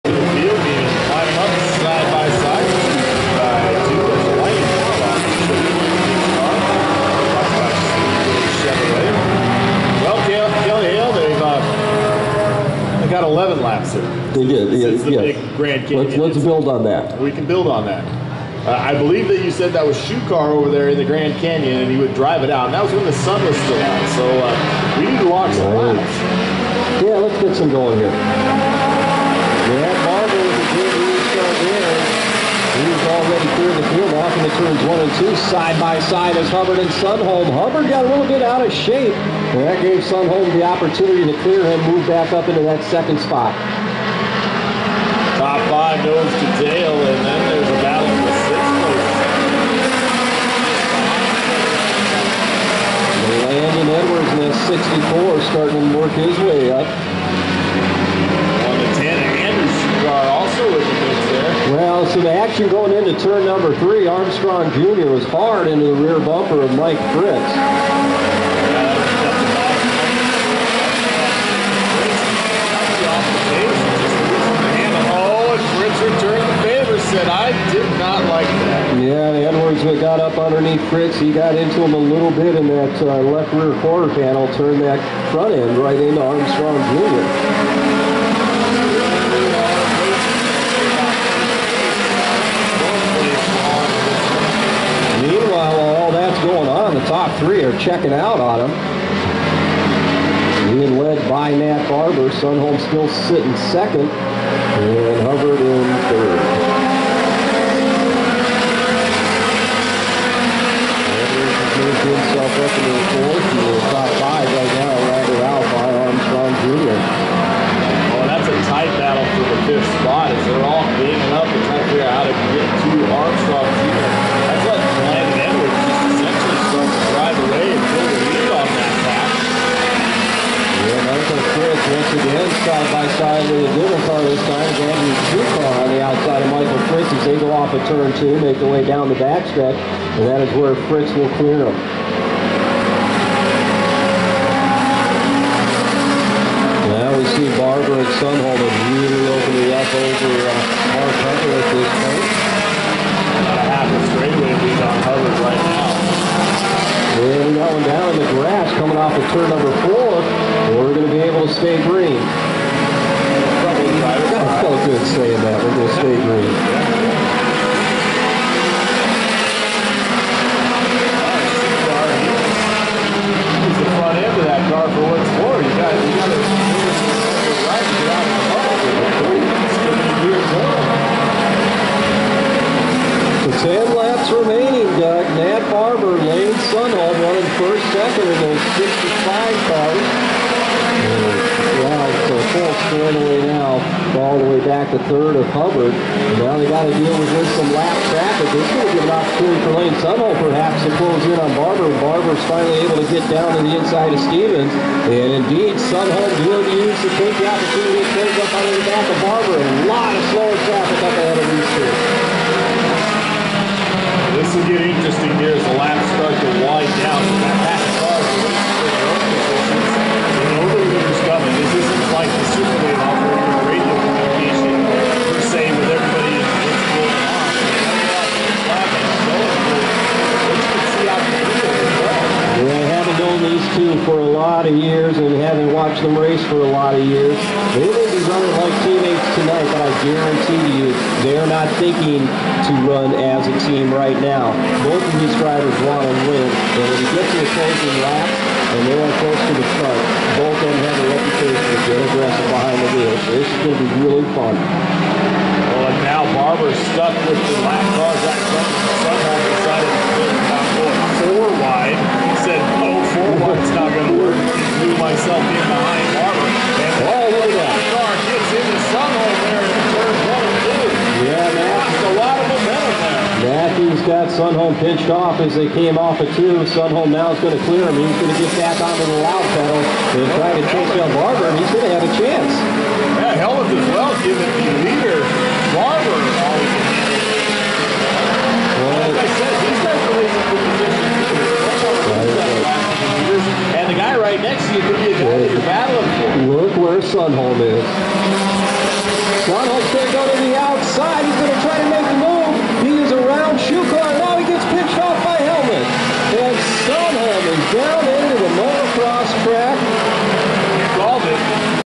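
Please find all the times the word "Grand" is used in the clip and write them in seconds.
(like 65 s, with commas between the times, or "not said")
15 s, 21 s.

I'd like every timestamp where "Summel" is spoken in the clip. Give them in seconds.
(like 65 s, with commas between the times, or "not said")
200 s, 205 s.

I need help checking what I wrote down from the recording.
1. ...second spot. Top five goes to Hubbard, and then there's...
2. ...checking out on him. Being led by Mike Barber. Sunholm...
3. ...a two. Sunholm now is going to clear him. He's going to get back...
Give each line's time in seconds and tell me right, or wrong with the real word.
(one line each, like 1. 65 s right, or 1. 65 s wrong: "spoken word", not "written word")
1. 42 s wrong: "Dale", not "Hubbard"
2. 97 s wrong: "Nat", not "Mike"
3. 276 s right.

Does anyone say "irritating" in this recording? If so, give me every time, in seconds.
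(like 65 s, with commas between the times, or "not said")
not said.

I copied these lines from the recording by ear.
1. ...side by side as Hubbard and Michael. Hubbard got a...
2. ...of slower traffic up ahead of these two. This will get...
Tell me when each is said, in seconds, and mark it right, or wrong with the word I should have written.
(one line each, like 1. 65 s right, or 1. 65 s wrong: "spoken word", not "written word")
1. 35 s wrong: "Sunholm", not "Michael"
2. 210 s right.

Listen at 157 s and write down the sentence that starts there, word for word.
And we got one down in the grass coming off of turn number four.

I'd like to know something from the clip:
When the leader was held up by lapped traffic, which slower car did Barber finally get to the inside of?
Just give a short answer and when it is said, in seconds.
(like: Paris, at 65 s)
Stevens, at 204 s.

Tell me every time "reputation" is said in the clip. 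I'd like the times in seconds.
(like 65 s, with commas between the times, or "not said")
251 s.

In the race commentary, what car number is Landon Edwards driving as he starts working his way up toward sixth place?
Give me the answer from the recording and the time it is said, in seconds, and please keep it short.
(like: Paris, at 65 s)
64, at 55 s.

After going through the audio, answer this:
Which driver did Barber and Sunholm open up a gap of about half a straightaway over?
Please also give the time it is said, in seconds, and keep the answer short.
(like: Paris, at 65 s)
Mark Hunter, at 150 s.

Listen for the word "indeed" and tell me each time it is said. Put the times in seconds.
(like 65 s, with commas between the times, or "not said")
205 s.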